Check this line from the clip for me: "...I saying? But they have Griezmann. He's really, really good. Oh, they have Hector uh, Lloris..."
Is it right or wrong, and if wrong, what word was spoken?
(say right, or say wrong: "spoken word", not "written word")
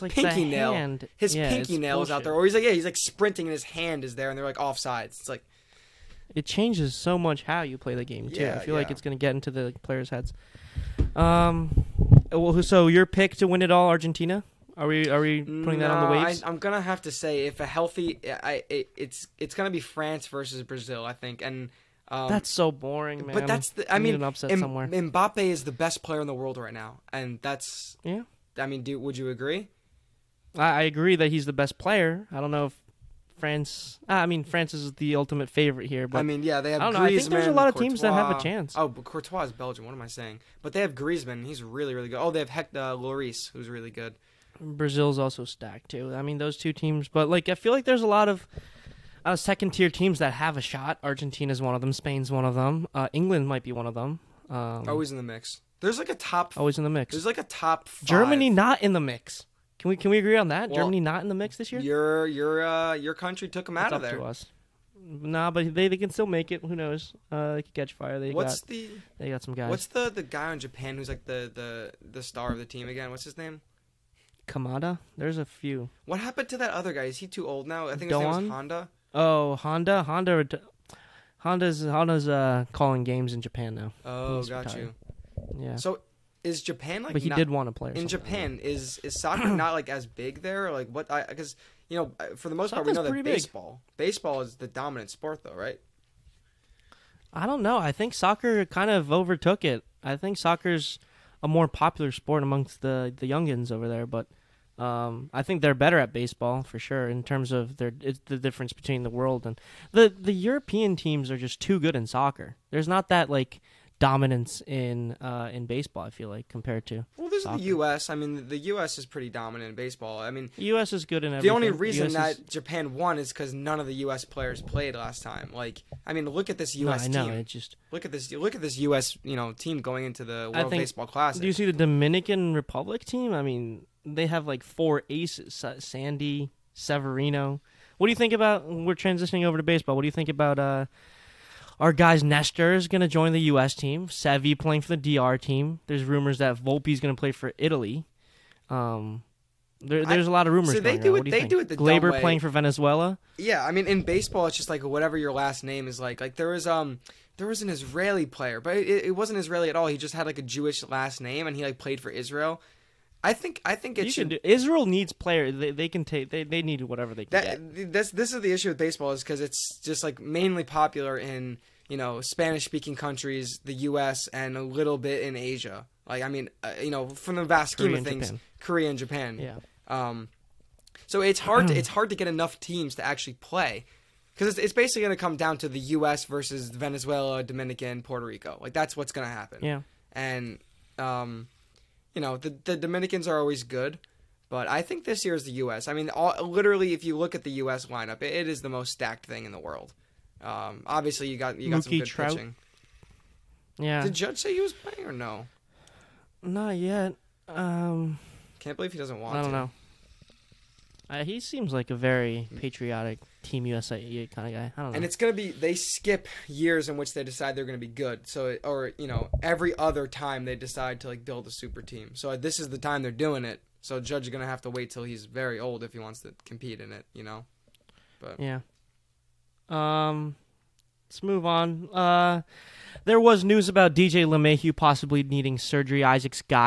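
right.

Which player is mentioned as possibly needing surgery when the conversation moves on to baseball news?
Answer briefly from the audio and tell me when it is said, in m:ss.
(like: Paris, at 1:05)
DJ LeMahieu, at 3:53.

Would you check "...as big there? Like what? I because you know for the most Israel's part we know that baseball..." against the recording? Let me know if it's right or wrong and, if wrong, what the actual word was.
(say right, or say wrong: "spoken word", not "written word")
wrong: "Soccer", not "Israel".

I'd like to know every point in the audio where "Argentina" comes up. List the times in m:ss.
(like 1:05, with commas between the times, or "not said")
0:13, 0:51.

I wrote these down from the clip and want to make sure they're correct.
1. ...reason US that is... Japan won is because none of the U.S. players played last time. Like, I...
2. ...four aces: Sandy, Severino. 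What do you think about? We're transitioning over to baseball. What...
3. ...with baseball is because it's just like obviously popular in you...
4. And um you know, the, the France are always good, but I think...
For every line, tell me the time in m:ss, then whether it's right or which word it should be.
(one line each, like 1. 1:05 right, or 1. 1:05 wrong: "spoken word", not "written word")
1. 2:01 right
2. 2:14 right
3. 2:48 wrong: "mainly", not "obviously"
4. 3:10 wrong: "Dominicans", not "France".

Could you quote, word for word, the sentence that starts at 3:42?
So uh, this is the time they're doing it.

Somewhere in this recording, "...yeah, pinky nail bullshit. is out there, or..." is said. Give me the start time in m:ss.
0:01.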